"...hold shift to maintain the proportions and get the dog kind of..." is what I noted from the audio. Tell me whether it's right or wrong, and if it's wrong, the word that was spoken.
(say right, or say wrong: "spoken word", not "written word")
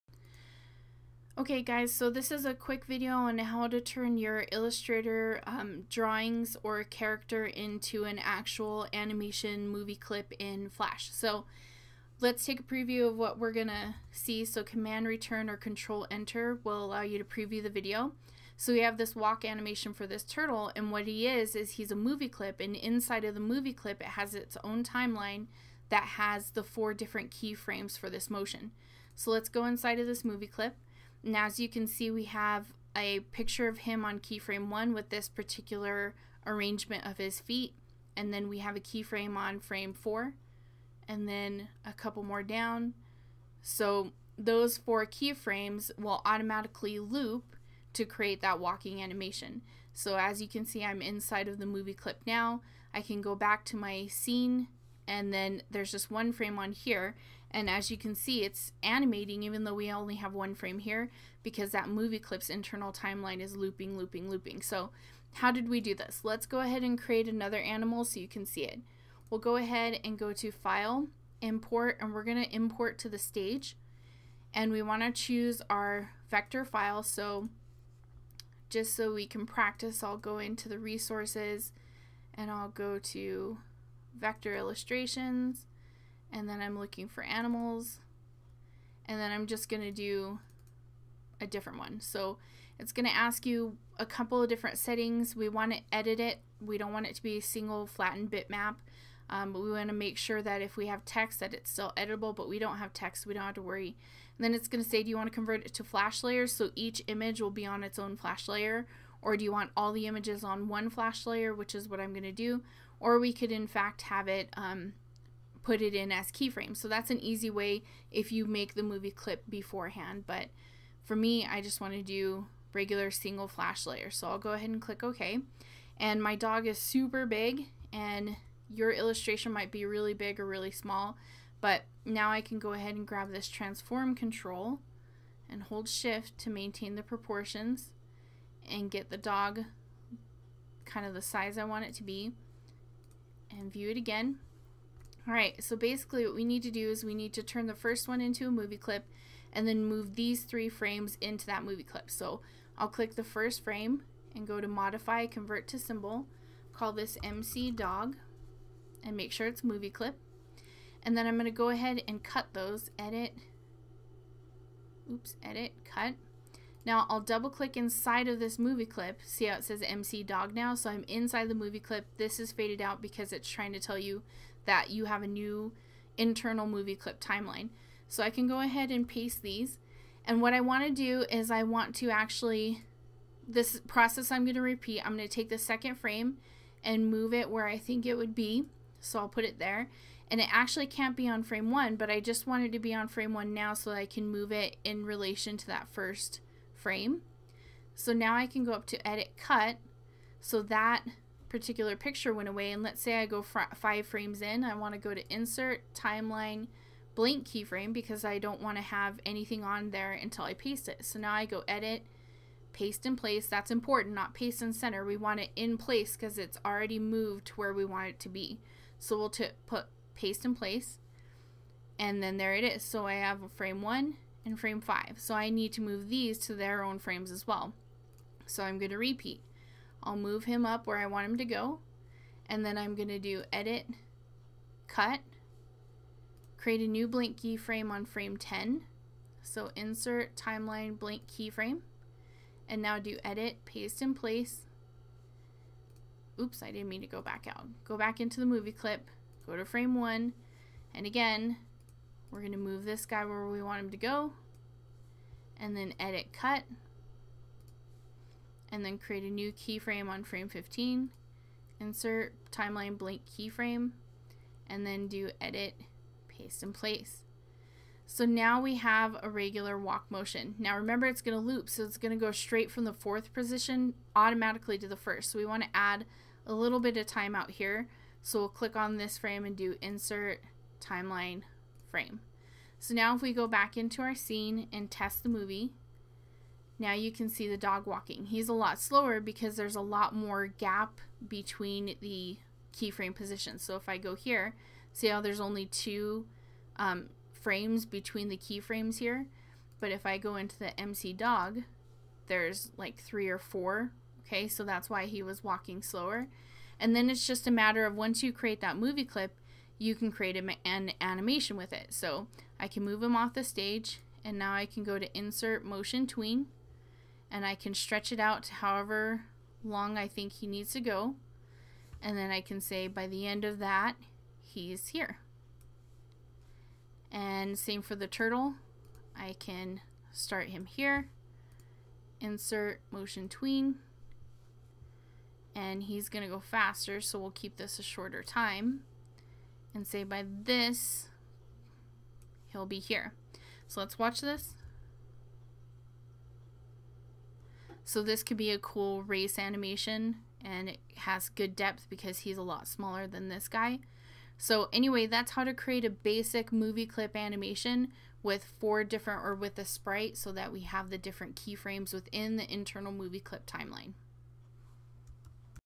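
right.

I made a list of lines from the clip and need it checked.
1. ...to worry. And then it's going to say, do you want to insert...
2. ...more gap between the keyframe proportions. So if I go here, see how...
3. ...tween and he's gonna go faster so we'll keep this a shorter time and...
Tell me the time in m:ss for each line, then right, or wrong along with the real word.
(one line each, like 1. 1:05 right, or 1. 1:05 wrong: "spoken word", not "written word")
1. 1:43 wrong: "convert", not "insert"
2. 4:50 wrong: "positions", not "proportions"
3. 5:33 right.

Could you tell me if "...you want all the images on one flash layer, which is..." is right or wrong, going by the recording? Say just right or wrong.
right.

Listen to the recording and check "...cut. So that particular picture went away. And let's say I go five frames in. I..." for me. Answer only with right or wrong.
right.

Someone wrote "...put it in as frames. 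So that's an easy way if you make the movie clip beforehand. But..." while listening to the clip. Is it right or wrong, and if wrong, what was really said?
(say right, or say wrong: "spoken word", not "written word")
wrong: "keyframes", not "frames".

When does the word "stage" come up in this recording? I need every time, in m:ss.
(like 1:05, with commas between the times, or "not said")
1:13, 5:13.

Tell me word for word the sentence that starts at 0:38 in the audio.
And then we have a keyframe on frame 4.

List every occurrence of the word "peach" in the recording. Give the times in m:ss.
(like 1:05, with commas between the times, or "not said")
not said.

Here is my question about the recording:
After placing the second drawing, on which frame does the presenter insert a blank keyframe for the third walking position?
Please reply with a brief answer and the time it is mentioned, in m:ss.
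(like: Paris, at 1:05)
10, at 3:58.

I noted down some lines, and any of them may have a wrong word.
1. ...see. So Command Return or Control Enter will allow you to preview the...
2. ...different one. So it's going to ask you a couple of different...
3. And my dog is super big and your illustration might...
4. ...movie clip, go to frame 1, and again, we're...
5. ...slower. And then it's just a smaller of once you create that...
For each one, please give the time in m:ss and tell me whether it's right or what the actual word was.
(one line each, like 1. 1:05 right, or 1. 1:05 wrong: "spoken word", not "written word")
1. 0:14 right
2. 1:31 right
3. 2:05 right
4. 4:08 right
5. 5:05 wrong: "matter", not "smaller".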